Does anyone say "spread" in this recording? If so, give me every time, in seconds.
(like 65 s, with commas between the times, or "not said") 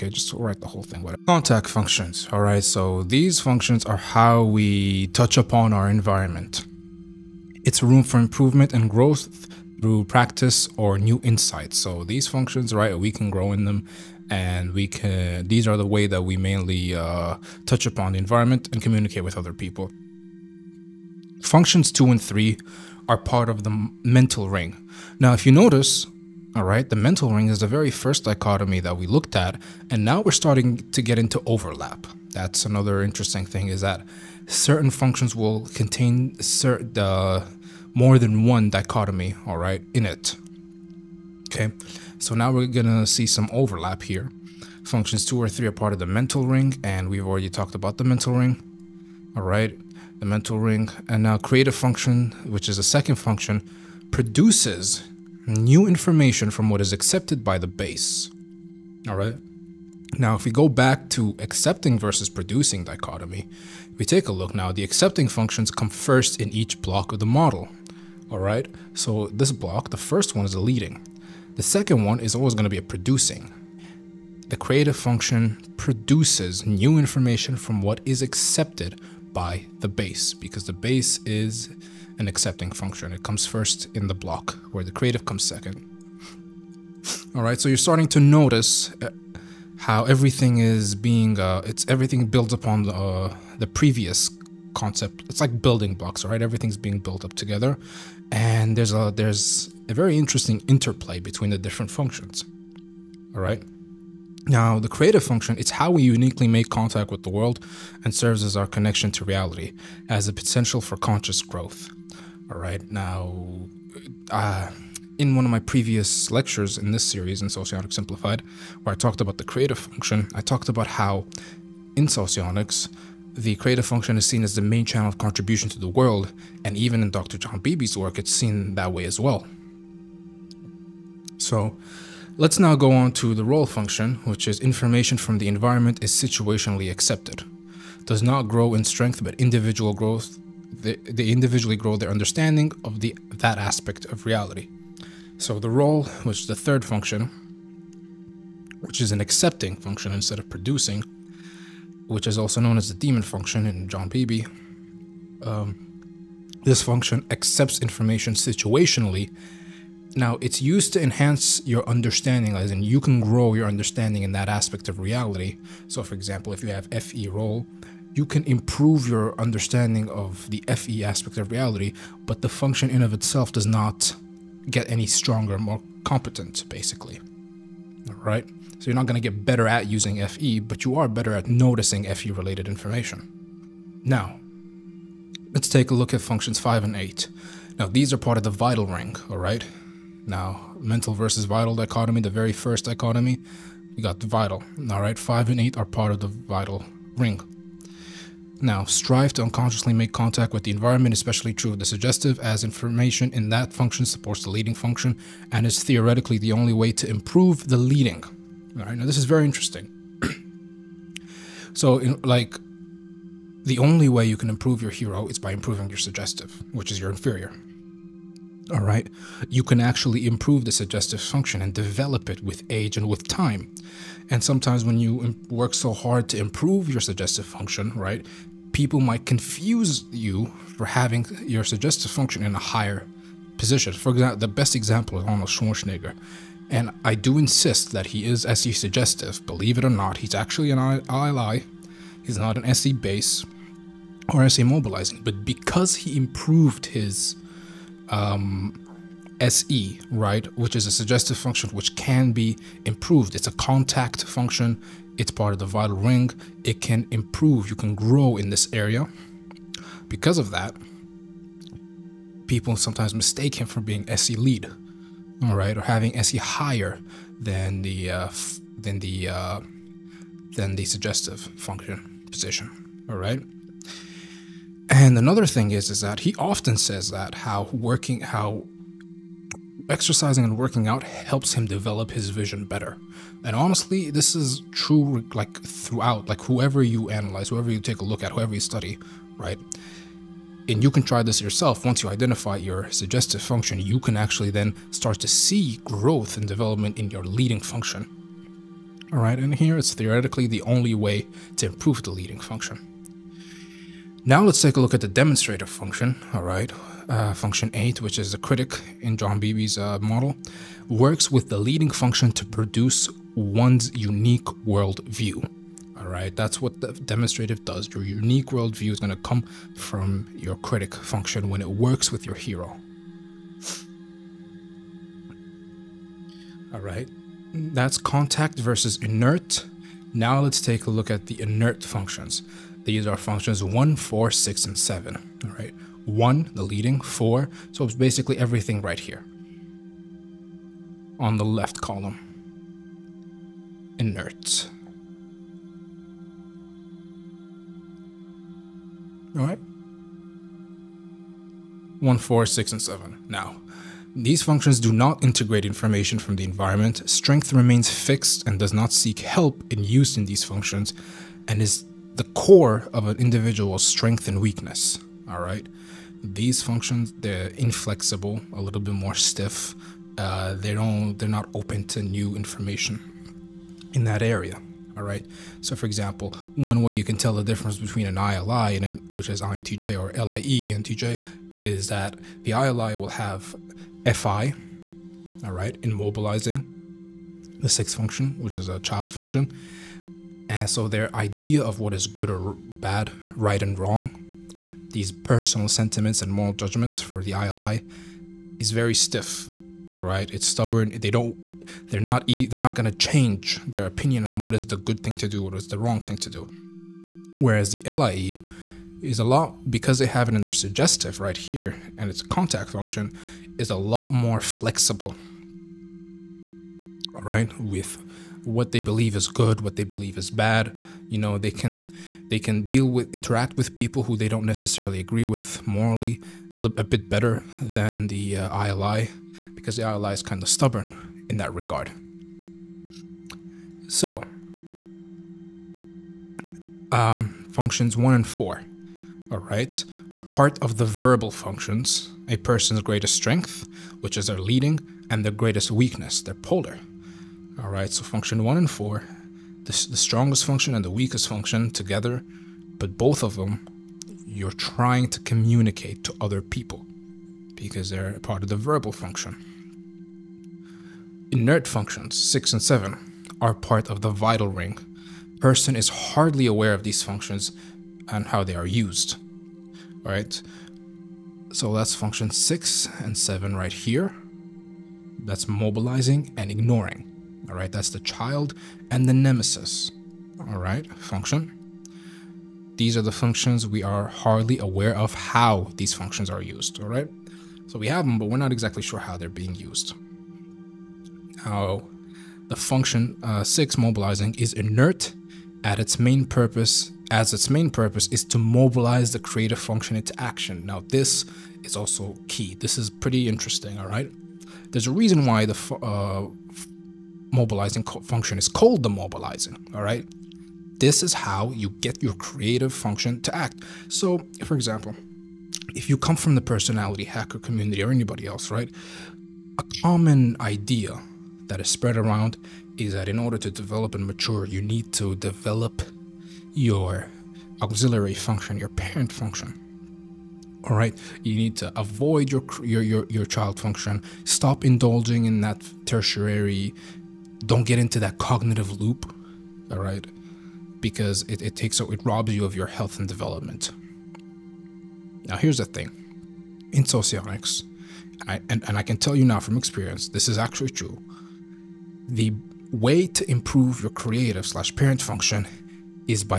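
521 s.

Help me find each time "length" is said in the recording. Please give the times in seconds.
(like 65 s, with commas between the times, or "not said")
not said.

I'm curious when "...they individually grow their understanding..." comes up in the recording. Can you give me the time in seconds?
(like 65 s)
140 s.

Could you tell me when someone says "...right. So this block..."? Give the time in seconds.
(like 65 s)
68 s.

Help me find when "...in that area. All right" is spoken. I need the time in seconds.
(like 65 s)
373 s.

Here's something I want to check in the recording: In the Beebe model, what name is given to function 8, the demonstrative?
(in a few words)
The critic.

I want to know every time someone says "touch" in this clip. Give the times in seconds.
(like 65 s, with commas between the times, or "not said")
5 s, 17 s.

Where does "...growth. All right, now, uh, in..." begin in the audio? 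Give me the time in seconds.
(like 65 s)
111 s.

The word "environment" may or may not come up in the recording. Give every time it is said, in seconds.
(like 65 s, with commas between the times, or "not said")
5 s, 18 s, 135 s, 200 s, 356 s.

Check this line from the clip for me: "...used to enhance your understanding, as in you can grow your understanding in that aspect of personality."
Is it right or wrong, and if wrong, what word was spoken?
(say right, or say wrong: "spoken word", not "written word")
wrong: "reality", not "personality".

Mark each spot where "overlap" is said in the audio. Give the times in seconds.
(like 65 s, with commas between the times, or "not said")
31 s, 43 s.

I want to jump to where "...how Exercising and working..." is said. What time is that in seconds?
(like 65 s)
278 s.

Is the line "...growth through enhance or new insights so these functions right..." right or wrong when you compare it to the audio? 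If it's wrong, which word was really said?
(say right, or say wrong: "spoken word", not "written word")
wrong: "practice", not "enhance".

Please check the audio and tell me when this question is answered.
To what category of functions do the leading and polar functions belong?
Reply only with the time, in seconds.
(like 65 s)
440 s.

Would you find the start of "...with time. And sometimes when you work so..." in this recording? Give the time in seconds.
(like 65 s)
223 s.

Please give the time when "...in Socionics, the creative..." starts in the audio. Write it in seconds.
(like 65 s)
121 s.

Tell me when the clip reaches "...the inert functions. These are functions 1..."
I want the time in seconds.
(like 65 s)
331 s.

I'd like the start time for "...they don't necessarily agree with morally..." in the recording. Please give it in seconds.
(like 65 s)
424 s.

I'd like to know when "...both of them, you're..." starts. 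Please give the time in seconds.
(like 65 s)
452 s.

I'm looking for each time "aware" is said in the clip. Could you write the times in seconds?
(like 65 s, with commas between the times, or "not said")
466 s, 484 s.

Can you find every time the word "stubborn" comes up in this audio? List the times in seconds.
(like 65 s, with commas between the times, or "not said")
400 s, 430 s.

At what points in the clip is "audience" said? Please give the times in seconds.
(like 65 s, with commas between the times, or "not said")
not said.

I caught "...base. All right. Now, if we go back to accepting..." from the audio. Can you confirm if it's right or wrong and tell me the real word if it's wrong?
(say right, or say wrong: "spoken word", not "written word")
right.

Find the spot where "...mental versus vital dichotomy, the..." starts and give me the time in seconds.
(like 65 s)
190 s.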